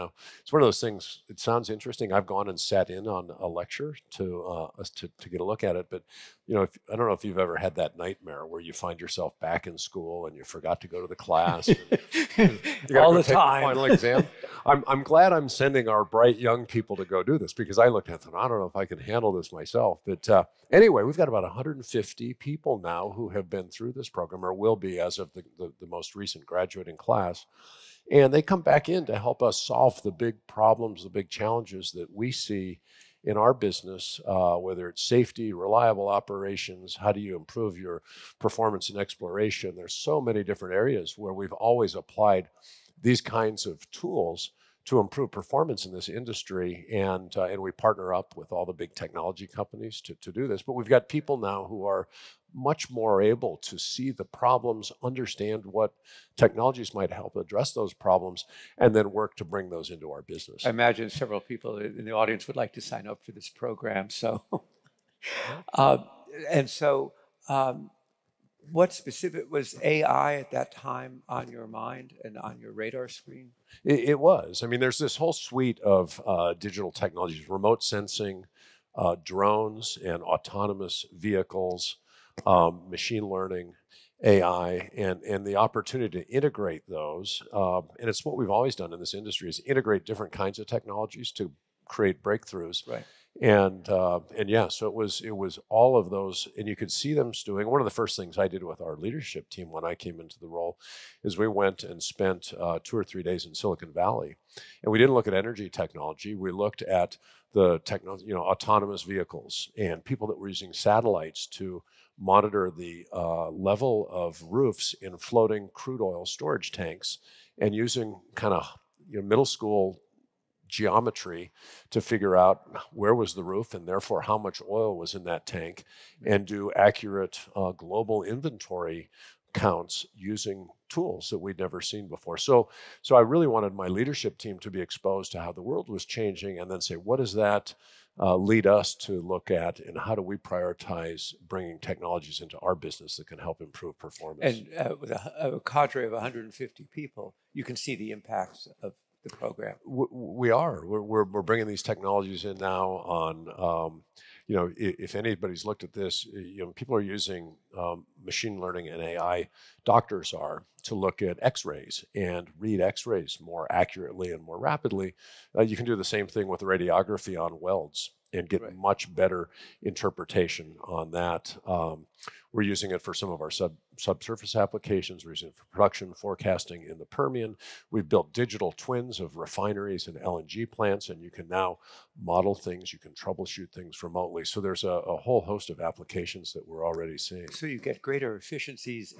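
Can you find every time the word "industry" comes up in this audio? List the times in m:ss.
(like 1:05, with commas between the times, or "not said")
0:46, 1:29.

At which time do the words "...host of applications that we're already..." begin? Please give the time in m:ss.
3:05.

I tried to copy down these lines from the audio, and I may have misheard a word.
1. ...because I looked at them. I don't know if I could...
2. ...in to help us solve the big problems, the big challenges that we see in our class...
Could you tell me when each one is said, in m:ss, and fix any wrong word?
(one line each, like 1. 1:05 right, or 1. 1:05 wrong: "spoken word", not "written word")
1. 0:17 right
2. 0:28 wrong: "business", not "class".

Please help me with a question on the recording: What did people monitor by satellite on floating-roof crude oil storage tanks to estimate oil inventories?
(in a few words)
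level of roofs.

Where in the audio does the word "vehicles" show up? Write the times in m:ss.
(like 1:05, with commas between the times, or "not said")
1:21, 1:49.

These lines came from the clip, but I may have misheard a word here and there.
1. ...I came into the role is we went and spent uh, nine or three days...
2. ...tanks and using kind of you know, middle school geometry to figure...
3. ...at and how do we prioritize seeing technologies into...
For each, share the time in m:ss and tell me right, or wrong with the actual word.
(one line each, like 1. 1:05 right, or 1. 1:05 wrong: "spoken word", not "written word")
1. 1:39 wrong: "two", not "nine"
2. 1:56 right
3. 2:19 wrong: "bringing", not "seeing".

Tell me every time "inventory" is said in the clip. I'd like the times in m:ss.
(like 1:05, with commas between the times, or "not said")
2:08.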